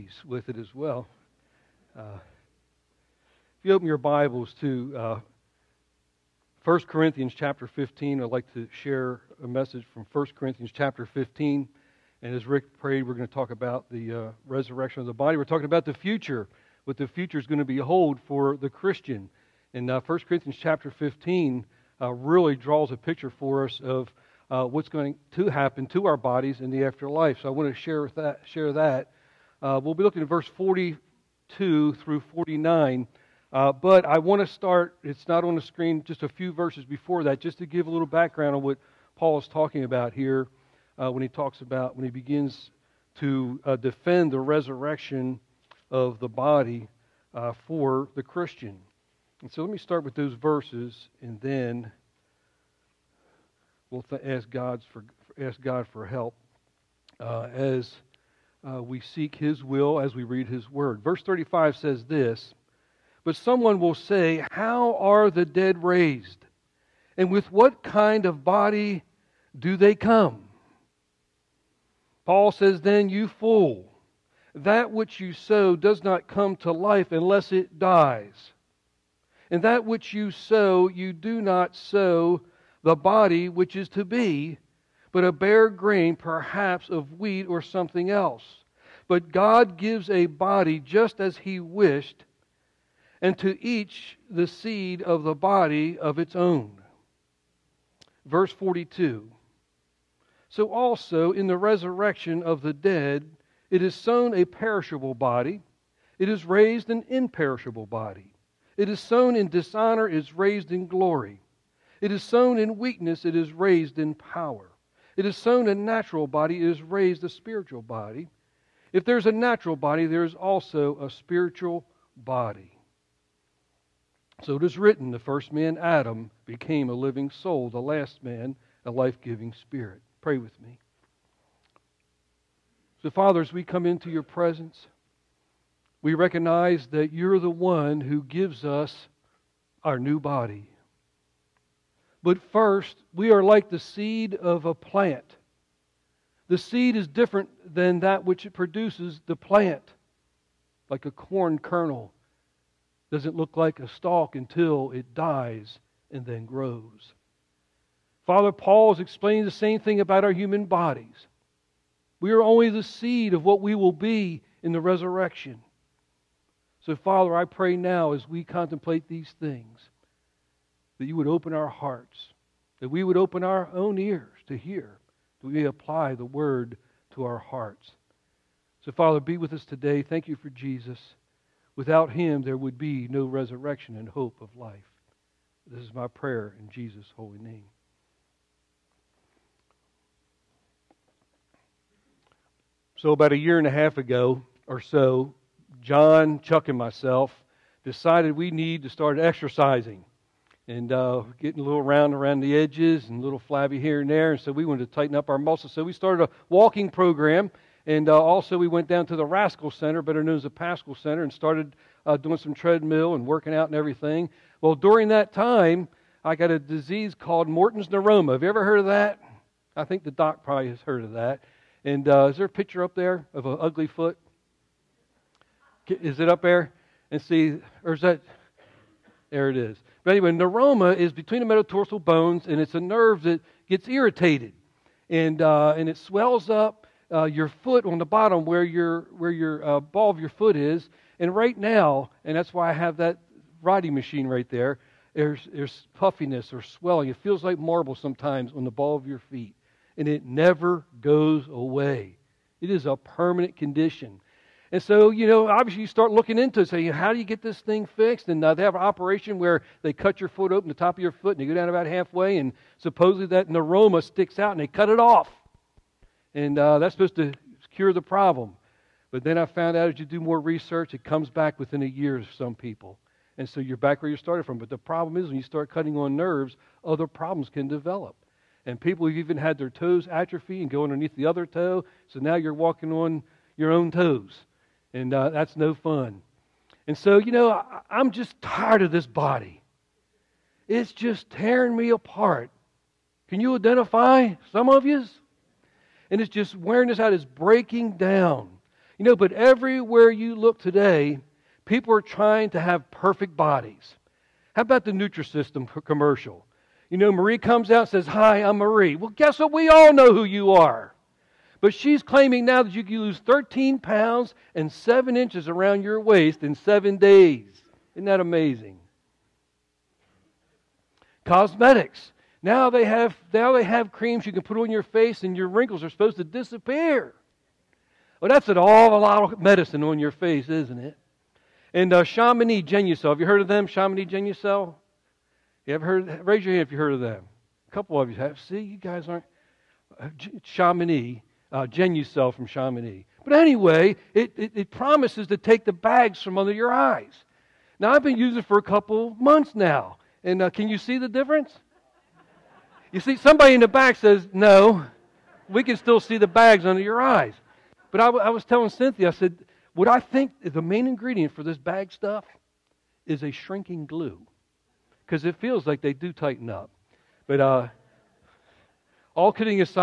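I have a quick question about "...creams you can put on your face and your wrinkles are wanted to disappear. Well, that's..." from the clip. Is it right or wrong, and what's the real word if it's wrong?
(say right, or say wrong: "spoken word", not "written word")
wrong: "supposed", not "wanted".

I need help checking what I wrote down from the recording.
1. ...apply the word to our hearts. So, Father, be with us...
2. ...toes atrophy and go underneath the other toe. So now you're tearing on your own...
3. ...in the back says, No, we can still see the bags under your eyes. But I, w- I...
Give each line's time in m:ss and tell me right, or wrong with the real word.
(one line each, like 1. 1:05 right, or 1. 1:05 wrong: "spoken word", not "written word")
1. 2:55 right
2. 4:39 wrong: "walking", not "tearing"
3. 5:53 right.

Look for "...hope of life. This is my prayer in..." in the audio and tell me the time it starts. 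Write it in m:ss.
3:04.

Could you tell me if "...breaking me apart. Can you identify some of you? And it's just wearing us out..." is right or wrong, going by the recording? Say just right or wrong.
wrong.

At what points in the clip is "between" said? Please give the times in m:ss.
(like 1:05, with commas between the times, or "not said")
3:51.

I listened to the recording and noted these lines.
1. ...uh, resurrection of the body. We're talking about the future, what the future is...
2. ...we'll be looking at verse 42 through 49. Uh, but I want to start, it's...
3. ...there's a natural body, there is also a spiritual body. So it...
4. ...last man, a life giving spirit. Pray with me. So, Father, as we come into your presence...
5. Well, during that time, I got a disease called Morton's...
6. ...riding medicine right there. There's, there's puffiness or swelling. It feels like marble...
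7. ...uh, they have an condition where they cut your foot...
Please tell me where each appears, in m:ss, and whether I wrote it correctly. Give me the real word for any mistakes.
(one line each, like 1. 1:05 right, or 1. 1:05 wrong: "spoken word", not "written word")
1. 0:14 right
2. 0:29 right
3. 1:59 right
4. 2:07 right
5. 3:34 right
6. 4:03 wrong: "machine", not "medicine"
7. 4:18 wrong: "operation", not "condition".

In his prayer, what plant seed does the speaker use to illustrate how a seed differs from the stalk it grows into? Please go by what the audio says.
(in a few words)
Corn kernel.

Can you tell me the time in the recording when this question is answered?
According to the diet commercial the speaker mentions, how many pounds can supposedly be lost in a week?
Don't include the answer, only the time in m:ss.
5:13.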